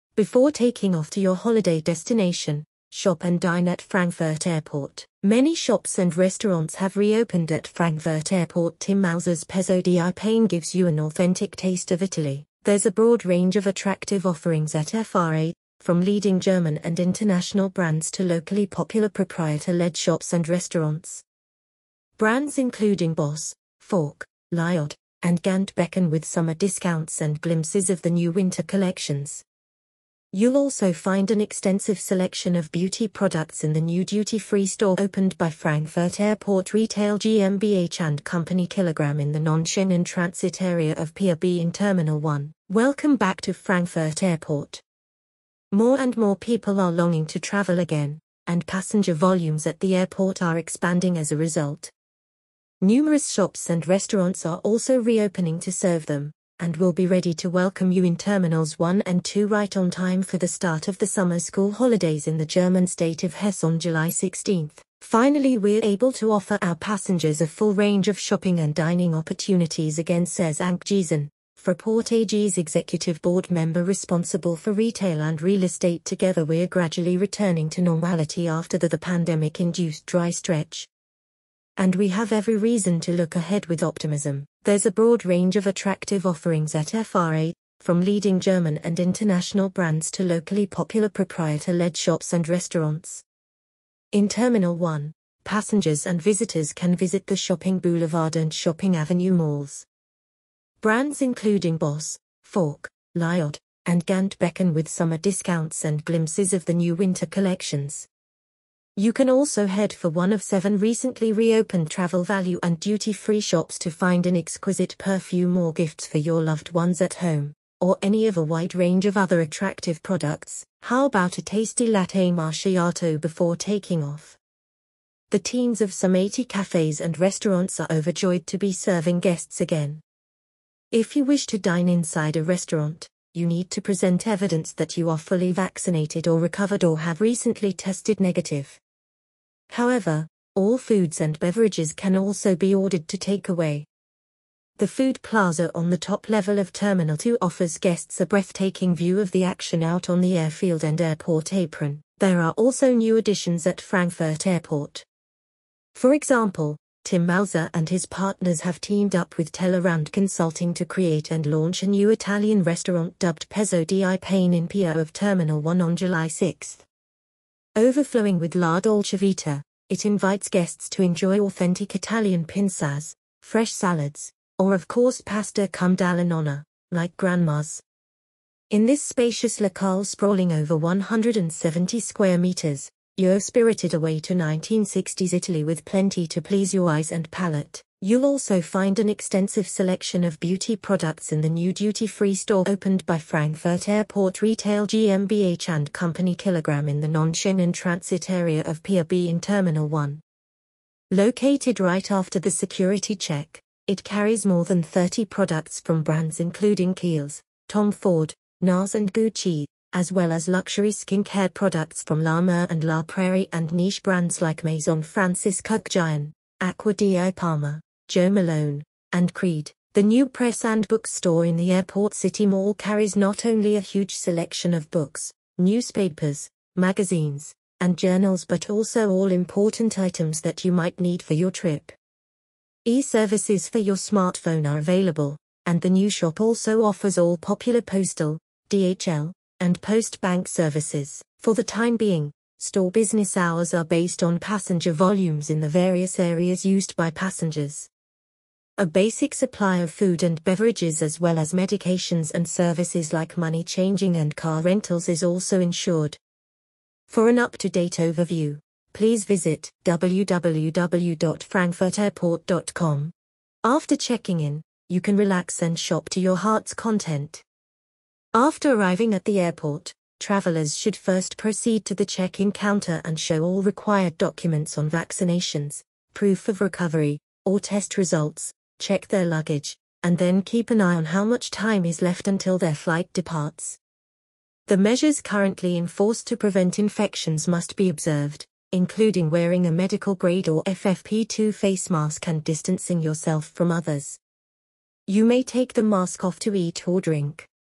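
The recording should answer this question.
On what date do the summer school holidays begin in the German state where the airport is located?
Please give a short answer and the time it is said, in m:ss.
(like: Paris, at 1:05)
July 16, at 1:03.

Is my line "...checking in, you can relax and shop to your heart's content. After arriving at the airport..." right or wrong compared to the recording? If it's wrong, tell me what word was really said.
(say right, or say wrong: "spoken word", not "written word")
right.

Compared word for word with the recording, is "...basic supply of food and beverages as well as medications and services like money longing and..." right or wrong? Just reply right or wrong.
wrong.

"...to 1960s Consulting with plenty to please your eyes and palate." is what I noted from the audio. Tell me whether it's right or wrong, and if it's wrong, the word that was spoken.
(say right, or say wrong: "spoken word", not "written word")
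wrong: "Italy", not "Consulting".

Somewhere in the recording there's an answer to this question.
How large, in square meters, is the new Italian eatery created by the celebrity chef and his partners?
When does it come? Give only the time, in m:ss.
3:00.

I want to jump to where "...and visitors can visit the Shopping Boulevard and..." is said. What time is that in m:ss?
1:36.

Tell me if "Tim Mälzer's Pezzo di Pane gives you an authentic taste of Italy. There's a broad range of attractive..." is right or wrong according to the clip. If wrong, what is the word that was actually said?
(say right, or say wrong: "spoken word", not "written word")
right.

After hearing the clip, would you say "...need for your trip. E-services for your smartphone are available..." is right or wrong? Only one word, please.
right.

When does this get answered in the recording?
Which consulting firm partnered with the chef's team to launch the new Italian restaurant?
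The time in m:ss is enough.
2:39.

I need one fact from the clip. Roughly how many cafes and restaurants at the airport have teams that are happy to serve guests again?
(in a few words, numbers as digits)
80.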